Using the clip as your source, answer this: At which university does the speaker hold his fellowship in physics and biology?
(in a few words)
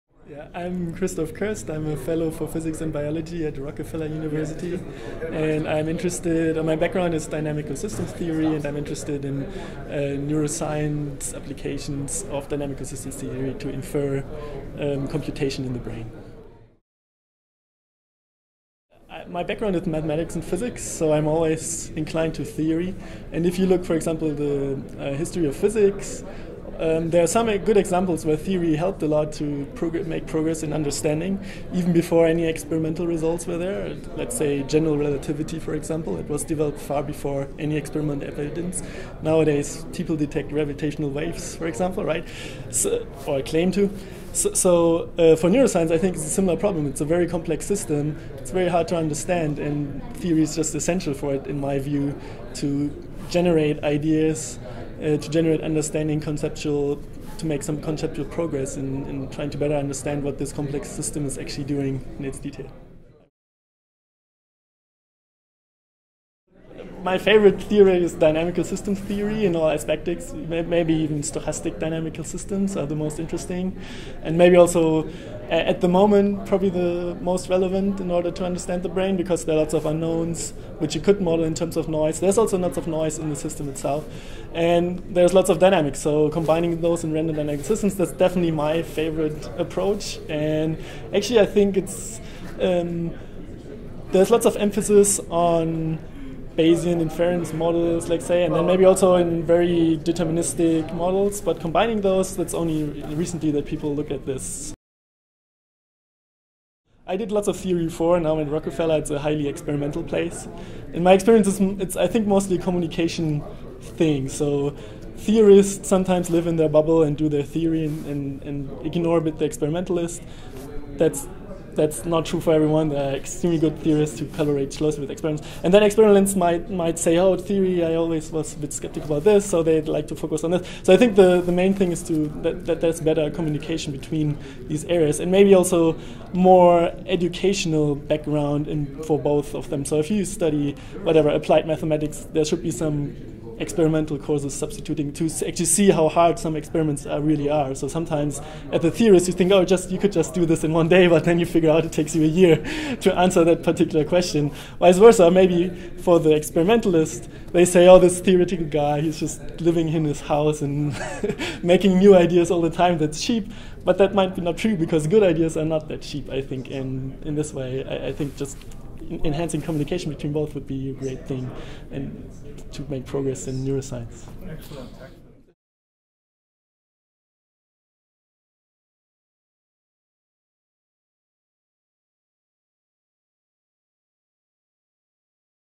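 Rockefeller University.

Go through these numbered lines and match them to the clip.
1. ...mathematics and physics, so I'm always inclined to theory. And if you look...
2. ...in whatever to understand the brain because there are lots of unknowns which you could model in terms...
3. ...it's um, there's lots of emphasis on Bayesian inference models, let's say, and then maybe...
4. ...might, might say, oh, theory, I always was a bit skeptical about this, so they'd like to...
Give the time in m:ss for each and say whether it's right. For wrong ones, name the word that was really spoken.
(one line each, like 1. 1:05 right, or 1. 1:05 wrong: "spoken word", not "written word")
1. 0:19 right
2. 1:17 wrong: "order", not "whatever"
3. 1:31 right
4. 2:06 right.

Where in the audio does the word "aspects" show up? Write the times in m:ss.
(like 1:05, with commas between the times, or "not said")
1:09.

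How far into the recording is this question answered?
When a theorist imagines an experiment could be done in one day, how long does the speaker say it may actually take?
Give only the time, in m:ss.
2:32.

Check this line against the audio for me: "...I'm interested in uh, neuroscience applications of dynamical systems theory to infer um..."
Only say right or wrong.
right.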